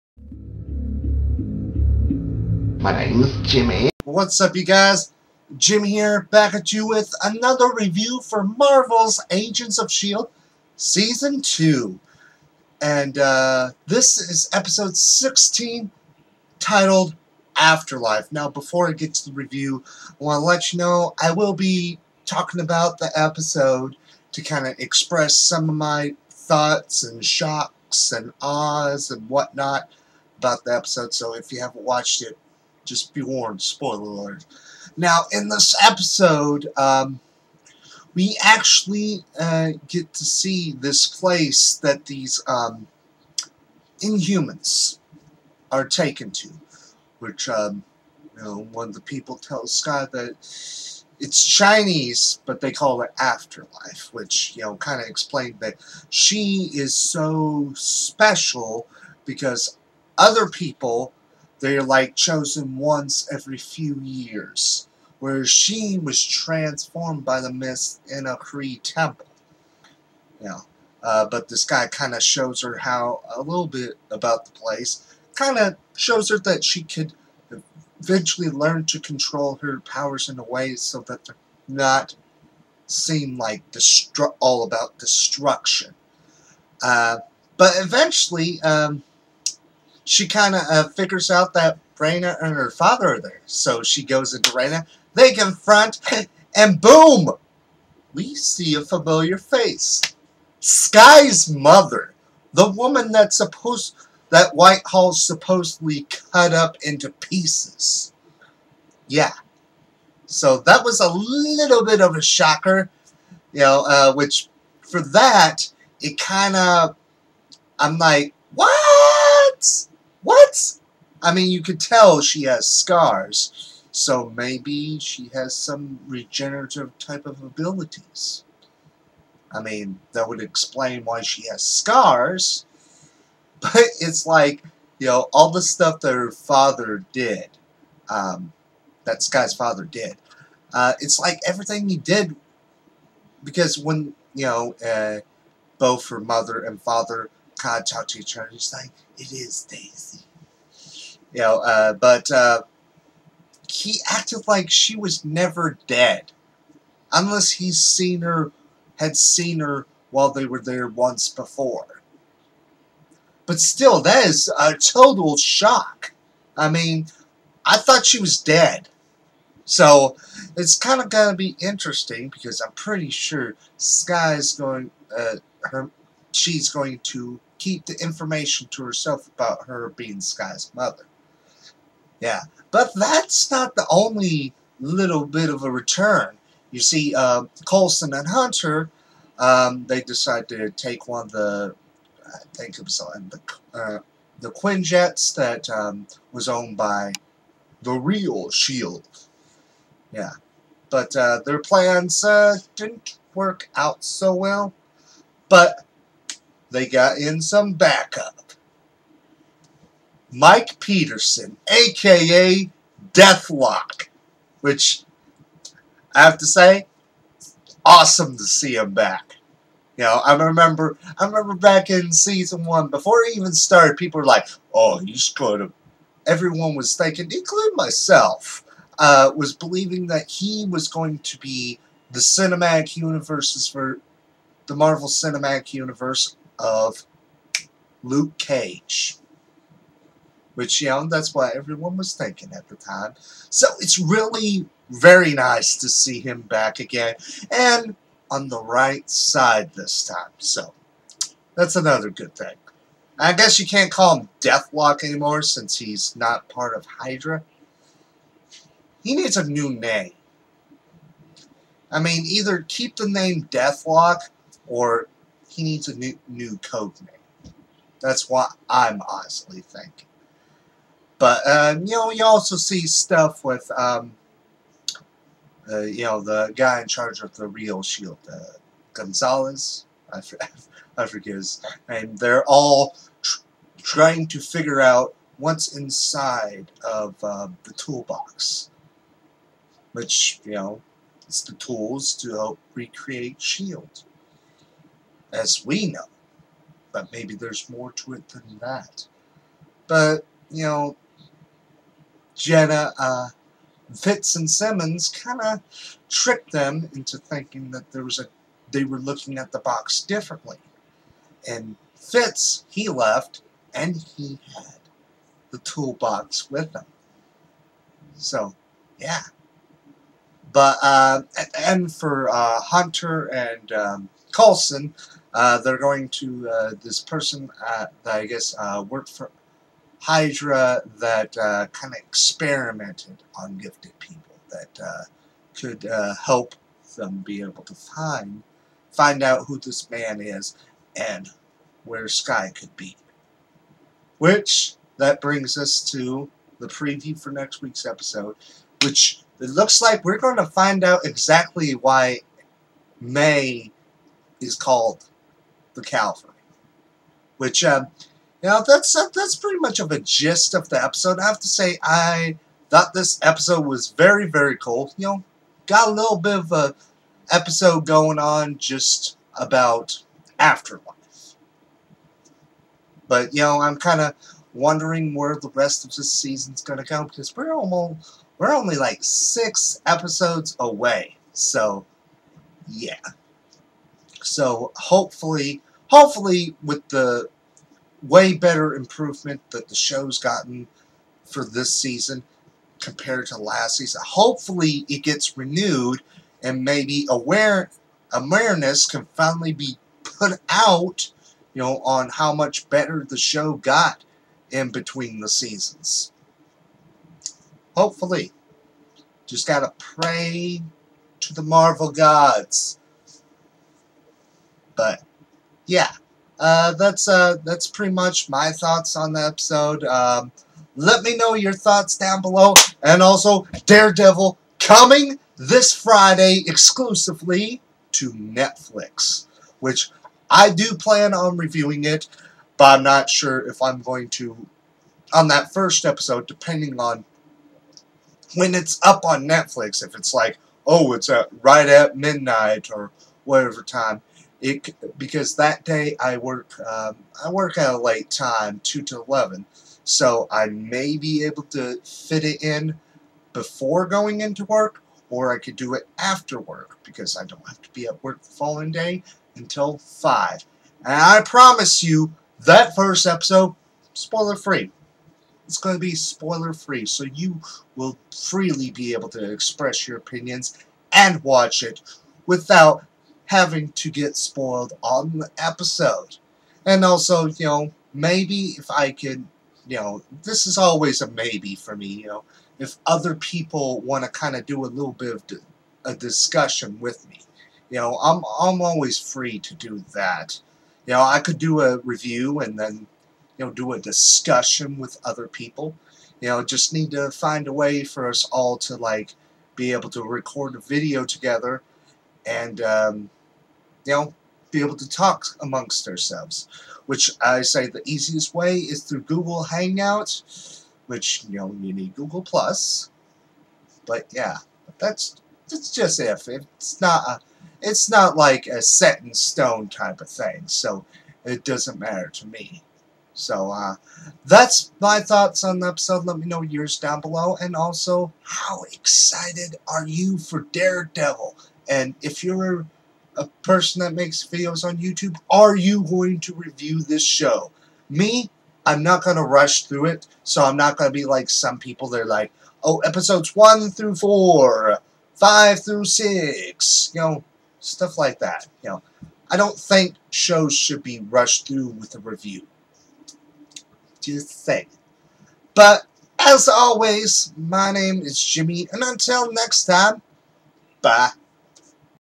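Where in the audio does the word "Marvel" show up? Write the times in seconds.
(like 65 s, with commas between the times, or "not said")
8 s, 234 s, 411 s.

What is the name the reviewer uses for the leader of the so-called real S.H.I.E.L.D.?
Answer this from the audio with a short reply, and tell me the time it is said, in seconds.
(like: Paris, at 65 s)
Gonzalez, at 278 s.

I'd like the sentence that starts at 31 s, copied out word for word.
So if you haven't watched it, just be warned, spoiler alert.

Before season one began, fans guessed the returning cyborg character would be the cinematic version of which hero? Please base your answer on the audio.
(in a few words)
Luke Cage.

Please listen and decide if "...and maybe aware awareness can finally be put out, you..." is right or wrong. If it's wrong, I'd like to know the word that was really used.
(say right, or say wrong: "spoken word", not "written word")
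right.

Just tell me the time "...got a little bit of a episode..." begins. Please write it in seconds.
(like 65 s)
365 s.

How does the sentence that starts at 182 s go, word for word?
Yeah, but that's not the only little bit of a return.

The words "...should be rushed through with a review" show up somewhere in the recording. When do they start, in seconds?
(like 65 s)
550 s.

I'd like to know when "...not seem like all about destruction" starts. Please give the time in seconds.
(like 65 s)
81 s.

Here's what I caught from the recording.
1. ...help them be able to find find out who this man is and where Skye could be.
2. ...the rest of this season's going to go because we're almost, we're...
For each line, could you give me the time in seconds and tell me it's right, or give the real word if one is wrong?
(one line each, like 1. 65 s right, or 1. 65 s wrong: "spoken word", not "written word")
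1. 336 s right
2. 375 s right.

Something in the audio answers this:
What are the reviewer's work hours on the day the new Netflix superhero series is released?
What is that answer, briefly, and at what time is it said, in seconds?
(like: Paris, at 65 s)
2 to 11, at 448 s.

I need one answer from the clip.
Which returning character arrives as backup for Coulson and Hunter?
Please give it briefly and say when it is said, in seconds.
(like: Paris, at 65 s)
Mike Peterson, at 210 s.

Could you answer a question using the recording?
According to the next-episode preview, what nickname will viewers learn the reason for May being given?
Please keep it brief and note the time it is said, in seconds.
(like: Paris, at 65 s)
the Calvary, at 355 s.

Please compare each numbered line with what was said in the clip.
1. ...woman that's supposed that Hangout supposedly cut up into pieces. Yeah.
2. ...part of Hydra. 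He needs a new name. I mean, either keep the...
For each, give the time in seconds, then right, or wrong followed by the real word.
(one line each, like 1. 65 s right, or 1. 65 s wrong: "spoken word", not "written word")
1. 102 s wrong: "Whitehall", not "Hangout"
2. 256 s right.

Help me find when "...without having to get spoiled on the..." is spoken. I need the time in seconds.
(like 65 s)
472 s.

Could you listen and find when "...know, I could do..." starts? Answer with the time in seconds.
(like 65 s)
490 s.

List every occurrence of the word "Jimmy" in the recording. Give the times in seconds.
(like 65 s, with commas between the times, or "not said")
3 s, 558 s.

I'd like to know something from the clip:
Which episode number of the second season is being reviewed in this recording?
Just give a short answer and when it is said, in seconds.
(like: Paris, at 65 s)
16, at 14 s.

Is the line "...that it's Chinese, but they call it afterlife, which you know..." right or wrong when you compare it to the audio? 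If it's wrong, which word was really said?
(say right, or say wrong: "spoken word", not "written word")
right.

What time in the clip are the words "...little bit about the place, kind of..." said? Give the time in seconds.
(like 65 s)
73 s.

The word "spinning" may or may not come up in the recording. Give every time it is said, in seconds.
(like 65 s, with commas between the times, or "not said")
not said.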